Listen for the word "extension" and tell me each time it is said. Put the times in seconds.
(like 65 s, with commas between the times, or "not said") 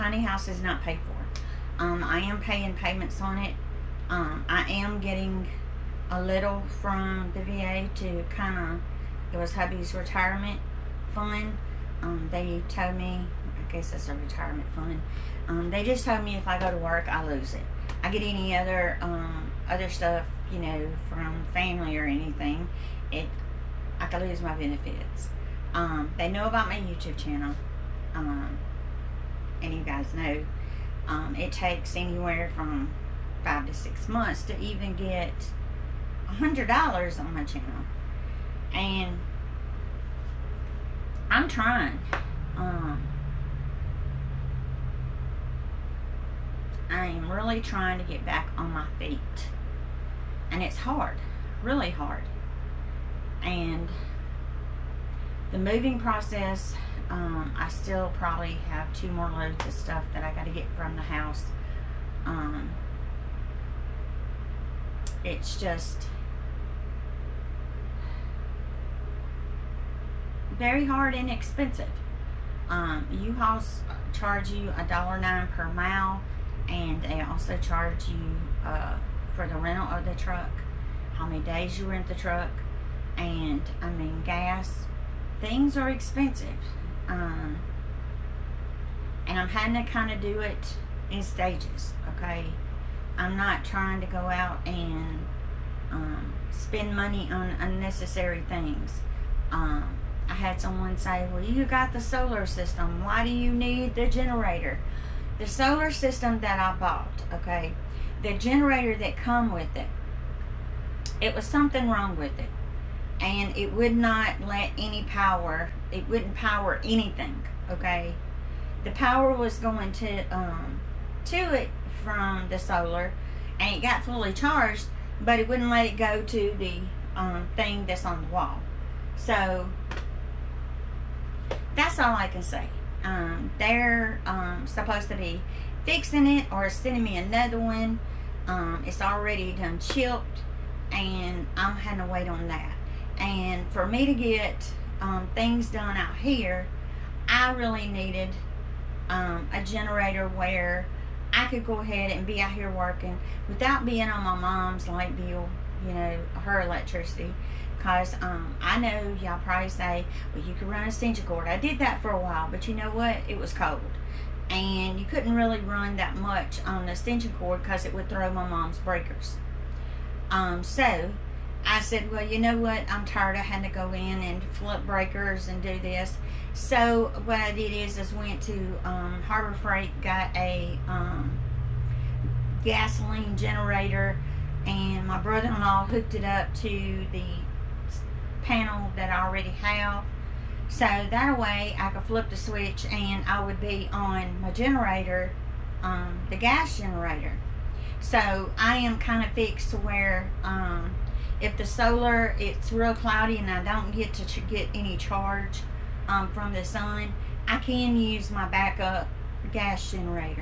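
160 s, 166 s.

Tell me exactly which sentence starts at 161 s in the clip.
I did that for a while, but you know what?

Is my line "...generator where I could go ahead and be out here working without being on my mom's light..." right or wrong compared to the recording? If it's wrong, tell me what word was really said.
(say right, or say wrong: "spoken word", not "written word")
right.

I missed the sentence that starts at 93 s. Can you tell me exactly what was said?
I'm not trying to go out and um, spend money on unnecessary things.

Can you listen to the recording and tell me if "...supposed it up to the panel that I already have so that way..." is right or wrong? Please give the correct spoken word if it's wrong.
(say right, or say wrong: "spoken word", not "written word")
wrong: "hooked", not "supposed".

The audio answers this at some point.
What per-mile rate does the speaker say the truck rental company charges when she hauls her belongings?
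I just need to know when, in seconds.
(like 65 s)
74 s.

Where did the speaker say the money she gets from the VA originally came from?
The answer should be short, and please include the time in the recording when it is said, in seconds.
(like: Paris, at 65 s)
Hubby's retirement fund, at 9 s.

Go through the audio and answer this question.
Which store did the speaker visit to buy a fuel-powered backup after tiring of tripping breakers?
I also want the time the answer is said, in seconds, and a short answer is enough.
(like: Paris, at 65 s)
Harbor Freight, at 179 s.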